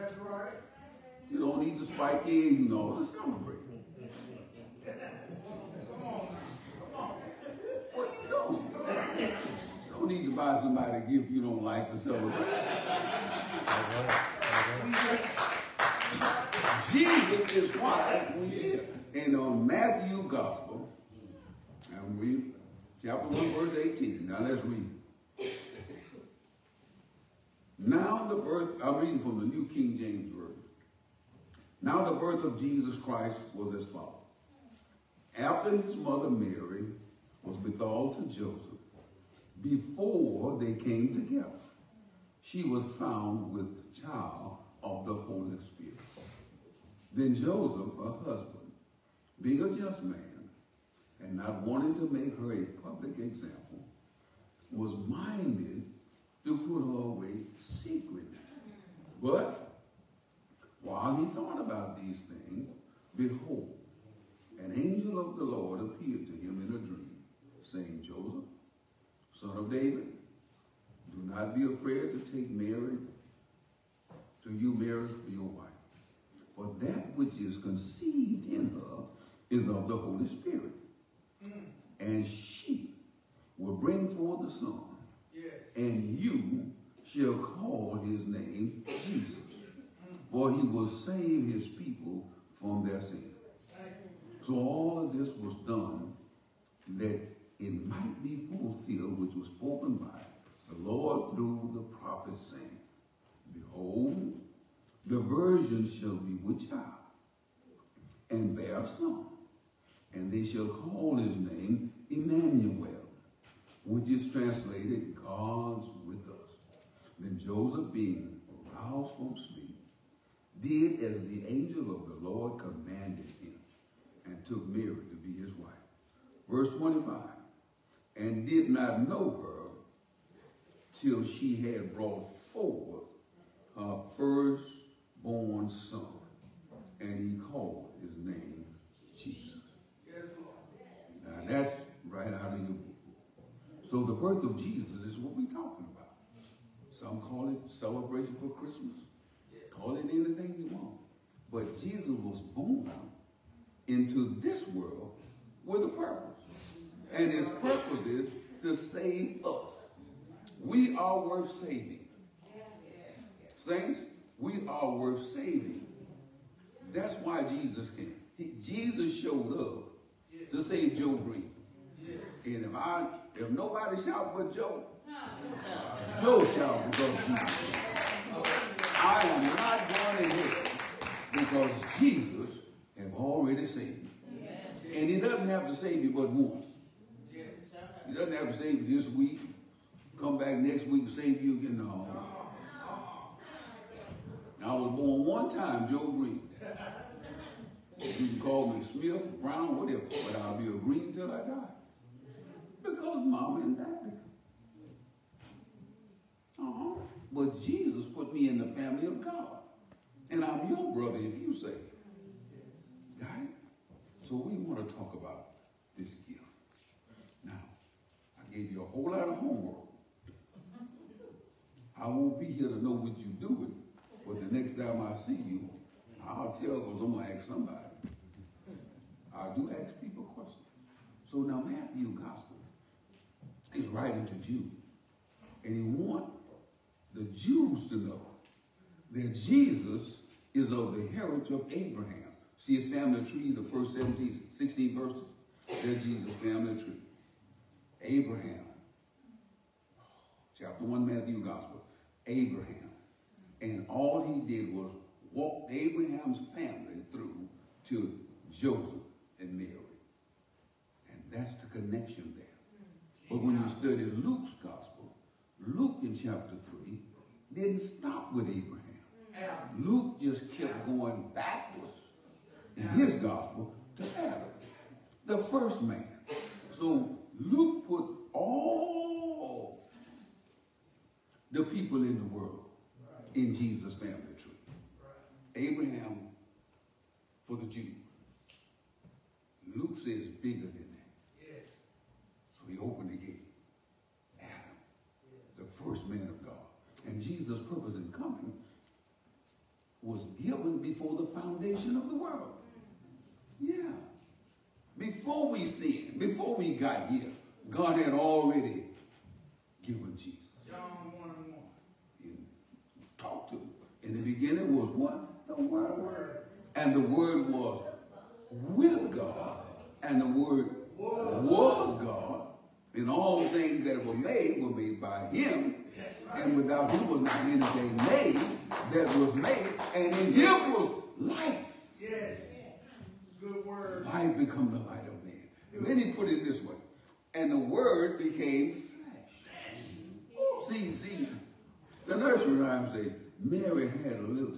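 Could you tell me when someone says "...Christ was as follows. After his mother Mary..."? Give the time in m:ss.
0:32.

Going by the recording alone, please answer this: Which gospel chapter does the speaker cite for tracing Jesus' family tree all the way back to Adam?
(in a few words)
Luke chapter 3.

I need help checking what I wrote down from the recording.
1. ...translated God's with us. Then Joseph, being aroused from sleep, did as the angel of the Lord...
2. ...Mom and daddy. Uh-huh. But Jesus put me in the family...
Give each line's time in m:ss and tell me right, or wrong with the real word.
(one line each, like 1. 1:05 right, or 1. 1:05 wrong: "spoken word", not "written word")
1. 1:54 right
2. 3:23 right.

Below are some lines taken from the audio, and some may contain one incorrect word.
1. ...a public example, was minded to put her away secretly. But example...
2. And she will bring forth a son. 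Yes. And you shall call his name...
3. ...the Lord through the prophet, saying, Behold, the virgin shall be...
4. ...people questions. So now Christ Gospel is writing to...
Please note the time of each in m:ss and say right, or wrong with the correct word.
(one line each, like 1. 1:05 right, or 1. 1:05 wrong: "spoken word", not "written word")
1. 0:52 wrong: "while", not "example"
2. 1:21 right
3. 1:40 right
4. 3:49 wrong: "Matthew", not "Christ".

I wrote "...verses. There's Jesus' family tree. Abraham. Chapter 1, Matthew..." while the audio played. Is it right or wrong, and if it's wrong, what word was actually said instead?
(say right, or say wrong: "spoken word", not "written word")
right.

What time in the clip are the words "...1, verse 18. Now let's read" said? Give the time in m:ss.
0:23.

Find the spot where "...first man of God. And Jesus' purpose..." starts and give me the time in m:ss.
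4:55.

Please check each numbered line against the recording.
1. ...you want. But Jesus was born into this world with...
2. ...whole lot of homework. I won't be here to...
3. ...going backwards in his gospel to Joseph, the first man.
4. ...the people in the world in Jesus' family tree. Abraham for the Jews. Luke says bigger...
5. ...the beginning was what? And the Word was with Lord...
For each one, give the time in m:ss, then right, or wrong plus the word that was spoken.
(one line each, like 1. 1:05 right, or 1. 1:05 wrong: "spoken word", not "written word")
1. 2:30 right
2. 3:38 right
3. 4:30 wrong: "Adam", not "Joseph"
4. 4:41 right
5. 5:14 wrong: "God", not "Lord".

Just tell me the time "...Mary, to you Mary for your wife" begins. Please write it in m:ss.
1:12.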